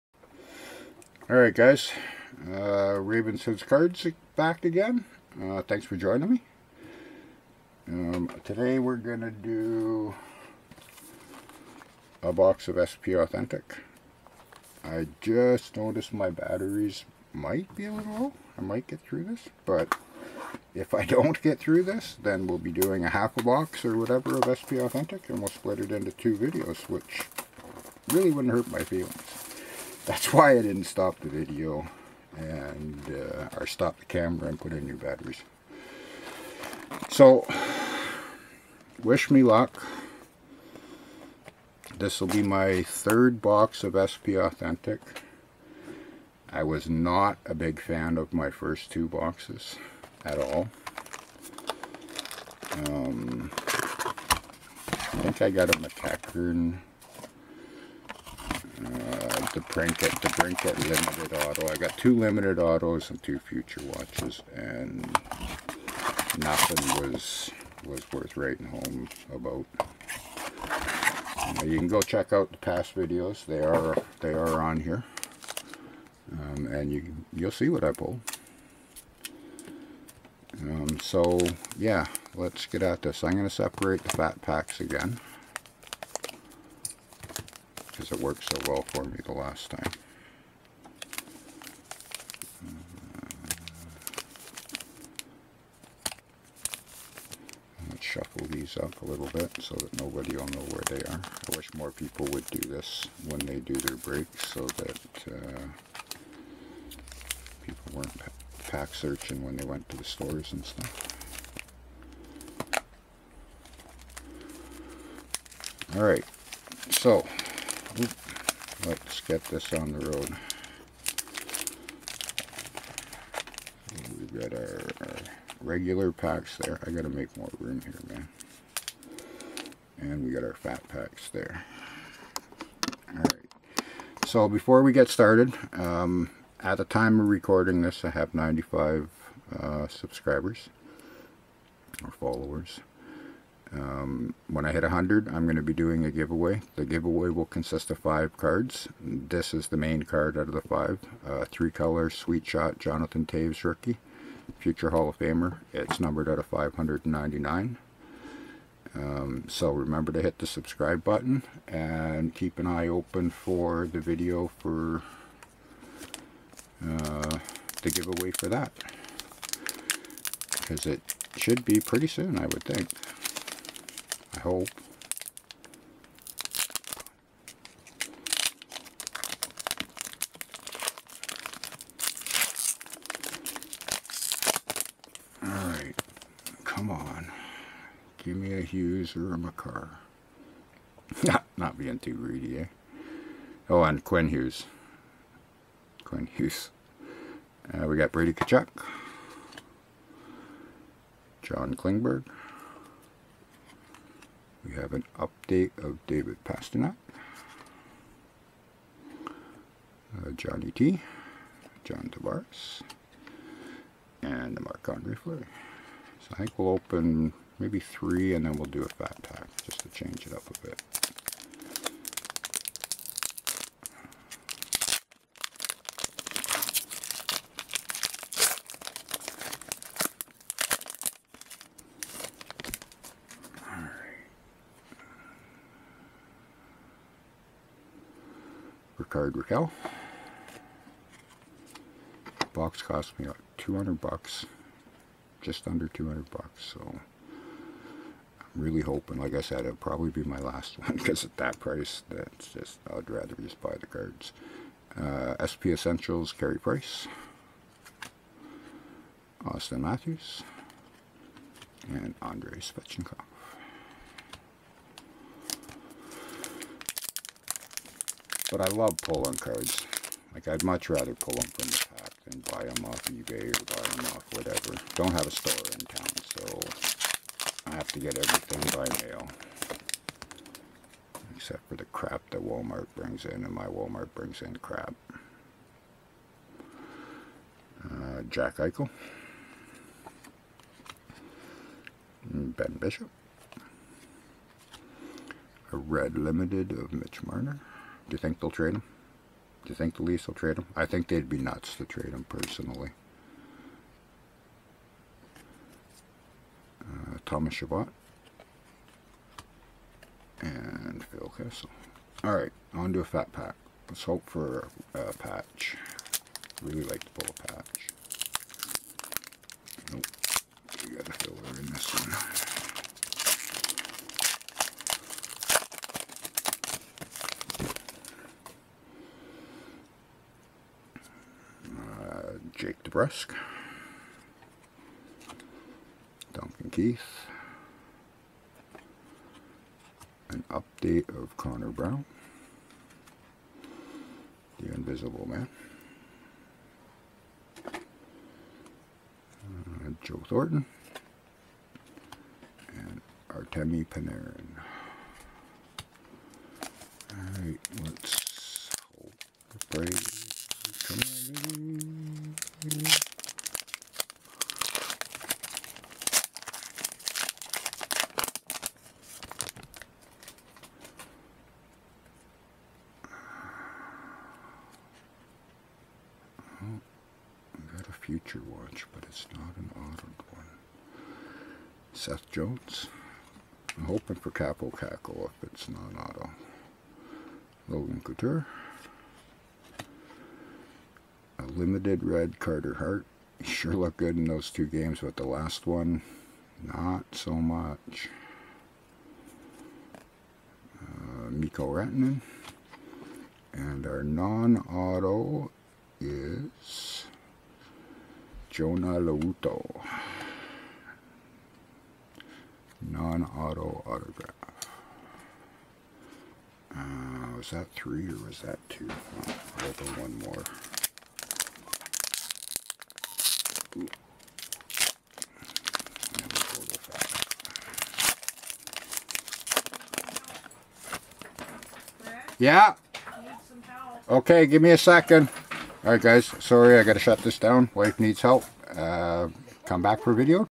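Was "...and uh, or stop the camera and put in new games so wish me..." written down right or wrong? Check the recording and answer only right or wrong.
wrong.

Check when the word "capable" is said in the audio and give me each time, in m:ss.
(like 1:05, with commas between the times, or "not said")
not said.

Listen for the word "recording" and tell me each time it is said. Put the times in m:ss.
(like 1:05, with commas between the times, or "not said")
2:17.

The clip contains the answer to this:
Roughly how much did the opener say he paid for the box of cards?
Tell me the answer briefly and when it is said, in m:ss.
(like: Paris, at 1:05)
just under 200 bucks, at 4:05.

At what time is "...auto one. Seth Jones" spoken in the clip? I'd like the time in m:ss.
6:19.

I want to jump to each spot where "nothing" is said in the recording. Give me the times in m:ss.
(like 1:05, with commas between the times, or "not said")
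1:06.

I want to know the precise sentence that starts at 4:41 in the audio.
Except for the crap that Walmart brings in, and my Walmart brings in crap.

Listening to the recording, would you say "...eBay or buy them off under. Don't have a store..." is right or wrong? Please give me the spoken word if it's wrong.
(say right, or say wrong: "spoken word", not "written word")
wrong: "whatever", not "under".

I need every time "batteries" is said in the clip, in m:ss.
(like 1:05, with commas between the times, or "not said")
0:16, 0:34.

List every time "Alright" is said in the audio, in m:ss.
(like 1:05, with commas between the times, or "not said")
0:01, 1:55, 2:13, 3:05, 5:57, 7:15.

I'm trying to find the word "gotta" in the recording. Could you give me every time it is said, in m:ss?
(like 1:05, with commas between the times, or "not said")
2:06, 7:16.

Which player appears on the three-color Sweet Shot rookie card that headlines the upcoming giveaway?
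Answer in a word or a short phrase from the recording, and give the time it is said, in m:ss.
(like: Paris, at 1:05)
Jonathan Toews, at 2:32.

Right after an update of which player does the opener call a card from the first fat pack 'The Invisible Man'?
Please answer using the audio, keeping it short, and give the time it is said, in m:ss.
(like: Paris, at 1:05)
Connor Brown, at 5:41.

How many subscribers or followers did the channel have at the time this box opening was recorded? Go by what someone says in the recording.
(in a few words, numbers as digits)
95.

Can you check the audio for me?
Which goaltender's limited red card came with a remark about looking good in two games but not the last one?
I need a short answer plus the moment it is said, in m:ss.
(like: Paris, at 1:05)
Carter Hart, at 6:32.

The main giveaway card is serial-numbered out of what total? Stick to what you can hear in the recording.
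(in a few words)
599.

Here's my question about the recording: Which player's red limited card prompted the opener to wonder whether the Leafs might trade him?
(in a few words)
Mitch Marner.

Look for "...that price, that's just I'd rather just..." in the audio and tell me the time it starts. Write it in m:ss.
4:11.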